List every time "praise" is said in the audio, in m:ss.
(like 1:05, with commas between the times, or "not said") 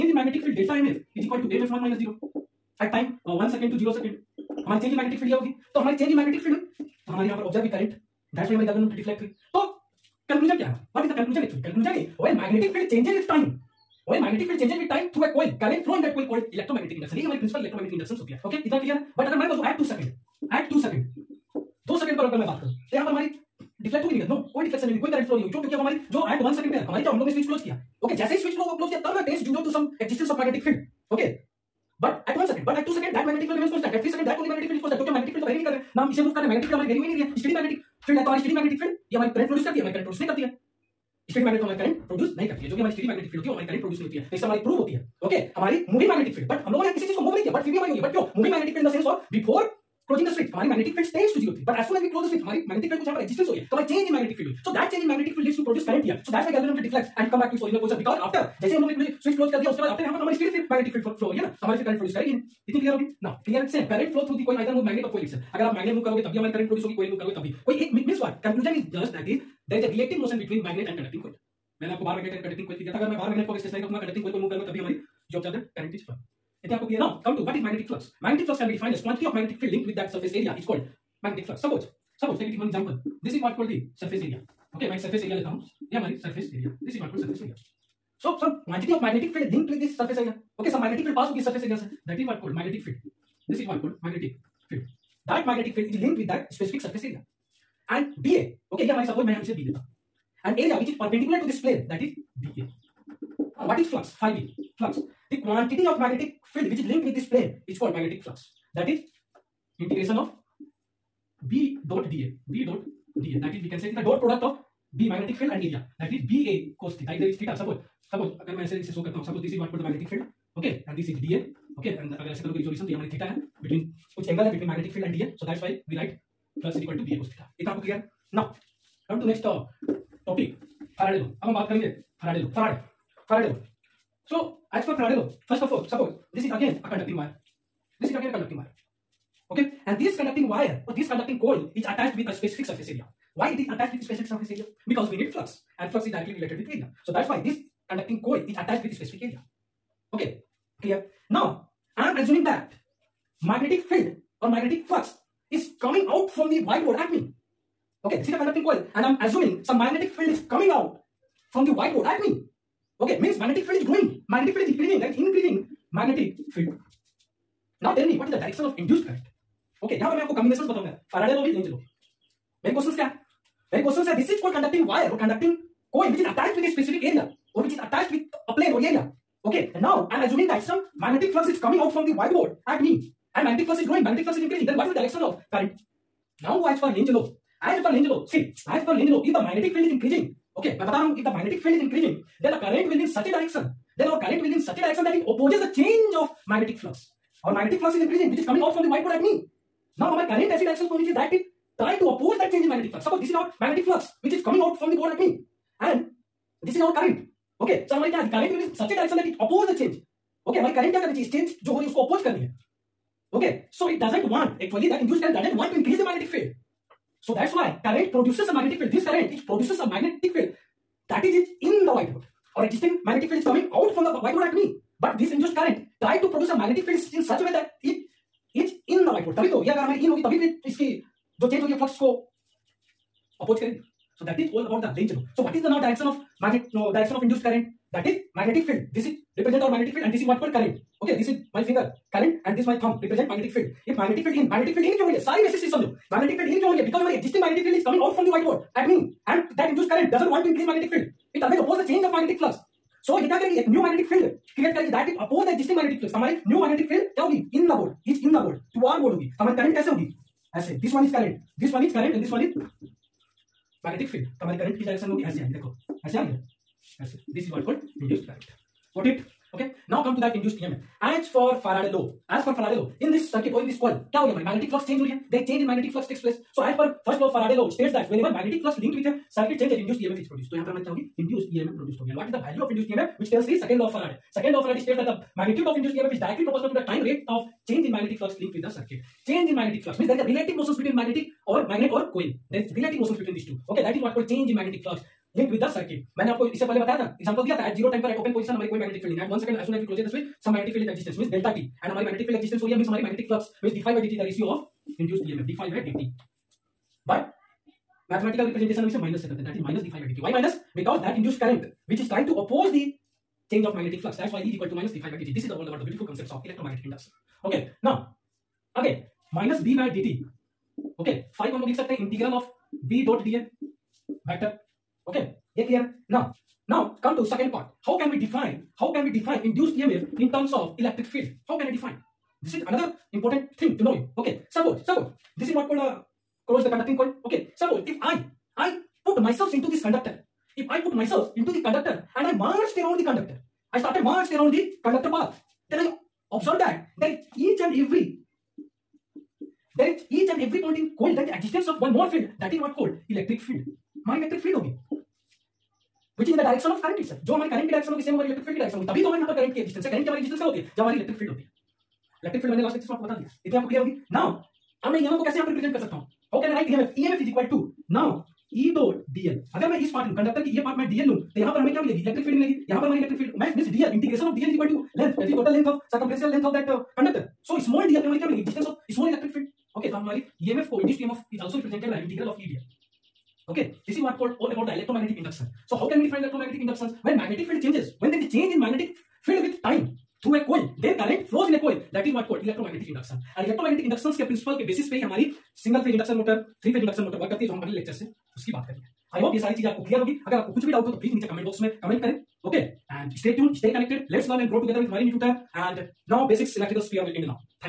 not said.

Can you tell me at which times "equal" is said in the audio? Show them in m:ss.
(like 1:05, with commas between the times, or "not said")
0:01, 5:14.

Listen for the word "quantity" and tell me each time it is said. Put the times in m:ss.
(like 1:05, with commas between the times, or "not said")
1:19, 1:28, 1:45.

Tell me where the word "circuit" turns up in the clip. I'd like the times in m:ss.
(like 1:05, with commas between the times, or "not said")
4:55.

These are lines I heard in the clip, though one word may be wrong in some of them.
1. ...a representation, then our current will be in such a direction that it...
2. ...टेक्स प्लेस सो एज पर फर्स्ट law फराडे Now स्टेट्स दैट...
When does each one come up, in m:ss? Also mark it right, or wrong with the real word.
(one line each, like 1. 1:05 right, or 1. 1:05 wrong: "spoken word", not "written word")
1. 3:13 wrong: "direction", not "representation"
2. 4:36 wrong: "Faraday", not "Now".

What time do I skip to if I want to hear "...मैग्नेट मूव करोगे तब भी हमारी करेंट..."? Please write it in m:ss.
1:05.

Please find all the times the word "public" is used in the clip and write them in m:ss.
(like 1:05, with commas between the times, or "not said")
not said.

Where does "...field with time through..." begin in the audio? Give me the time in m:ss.
6:29.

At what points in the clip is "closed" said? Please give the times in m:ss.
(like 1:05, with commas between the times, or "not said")
5:36.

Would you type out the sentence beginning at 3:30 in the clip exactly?
Okay, हमारी current क्या करनी चाहिए इस change जो हो रही है उसको oppose करनी है.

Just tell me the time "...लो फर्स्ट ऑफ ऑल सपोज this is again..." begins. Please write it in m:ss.
2:15.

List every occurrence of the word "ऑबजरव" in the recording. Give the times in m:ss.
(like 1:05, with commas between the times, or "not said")
0:07, 1:15.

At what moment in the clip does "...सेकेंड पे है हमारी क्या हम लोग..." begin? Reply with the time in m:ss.
0:26.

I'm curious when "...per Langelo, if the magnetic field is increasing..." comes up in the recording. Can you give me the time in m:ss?
3:08.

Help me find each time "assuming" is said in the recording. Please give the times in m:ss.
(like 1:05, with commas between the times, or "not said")
2:32, 2:39, 3:00.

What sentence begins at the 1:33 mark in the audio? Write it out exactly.
This is one called magnetic field.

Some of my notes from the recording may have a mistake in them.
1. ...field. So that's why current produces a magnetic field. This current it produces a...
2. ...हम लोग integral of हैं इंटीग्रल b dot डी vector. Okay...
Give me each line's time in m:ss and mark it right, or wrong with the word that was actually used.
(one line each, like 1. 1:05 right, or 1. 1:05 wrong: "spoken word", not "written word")
1. 3:36 right
2. 5:21 right.